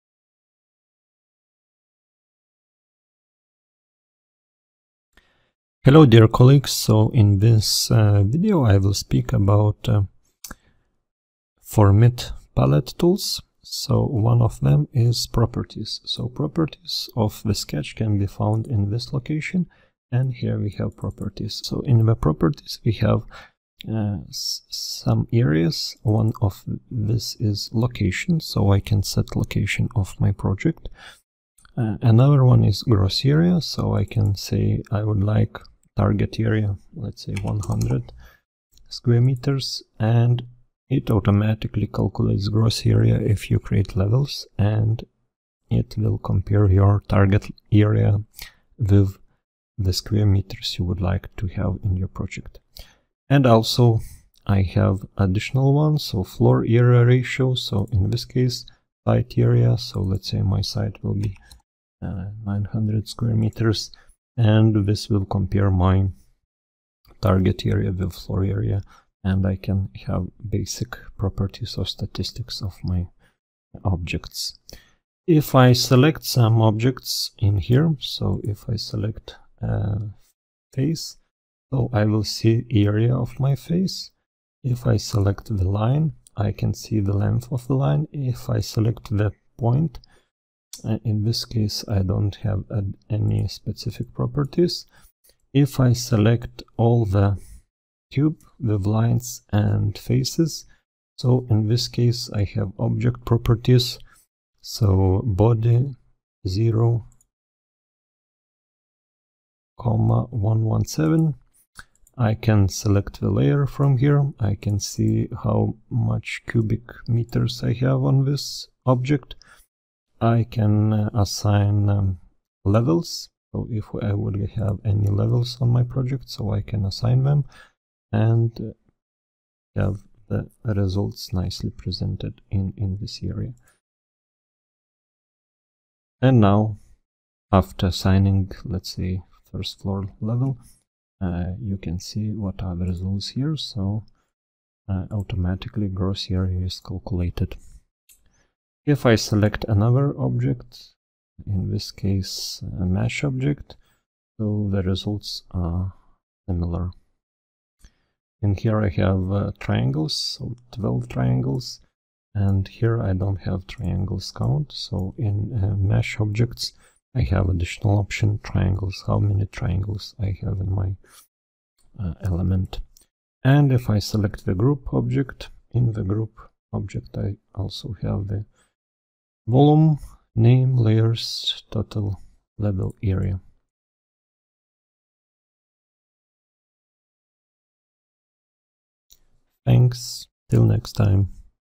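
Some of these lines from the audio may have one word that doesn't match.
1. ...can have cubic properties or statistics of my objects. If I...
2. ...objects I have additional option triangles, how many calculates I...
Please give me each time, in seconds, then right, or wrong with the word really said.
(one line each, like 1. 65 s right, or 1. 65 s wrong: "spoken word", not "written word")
1. 69 s wrong: "basic", not "cubic"
2. 166 s wrong: "triangles", not "calculates".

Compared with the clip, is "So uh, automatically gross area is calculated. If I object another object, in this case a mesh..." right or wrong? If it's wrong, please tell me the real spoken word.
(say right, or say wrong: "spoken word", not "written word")
wrong: "select", not "object".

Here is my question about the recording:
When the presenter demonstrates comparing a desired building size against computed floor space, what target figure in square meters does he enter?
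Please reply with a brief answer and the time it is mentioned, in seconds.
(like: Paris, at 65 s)
100 square meters, at 37 s.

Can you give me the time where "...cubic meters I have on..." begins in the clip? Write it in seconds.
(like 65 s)
116 s.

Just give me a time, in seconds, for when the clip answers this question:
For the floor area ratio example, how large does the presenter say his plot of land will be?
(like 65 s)
62 s.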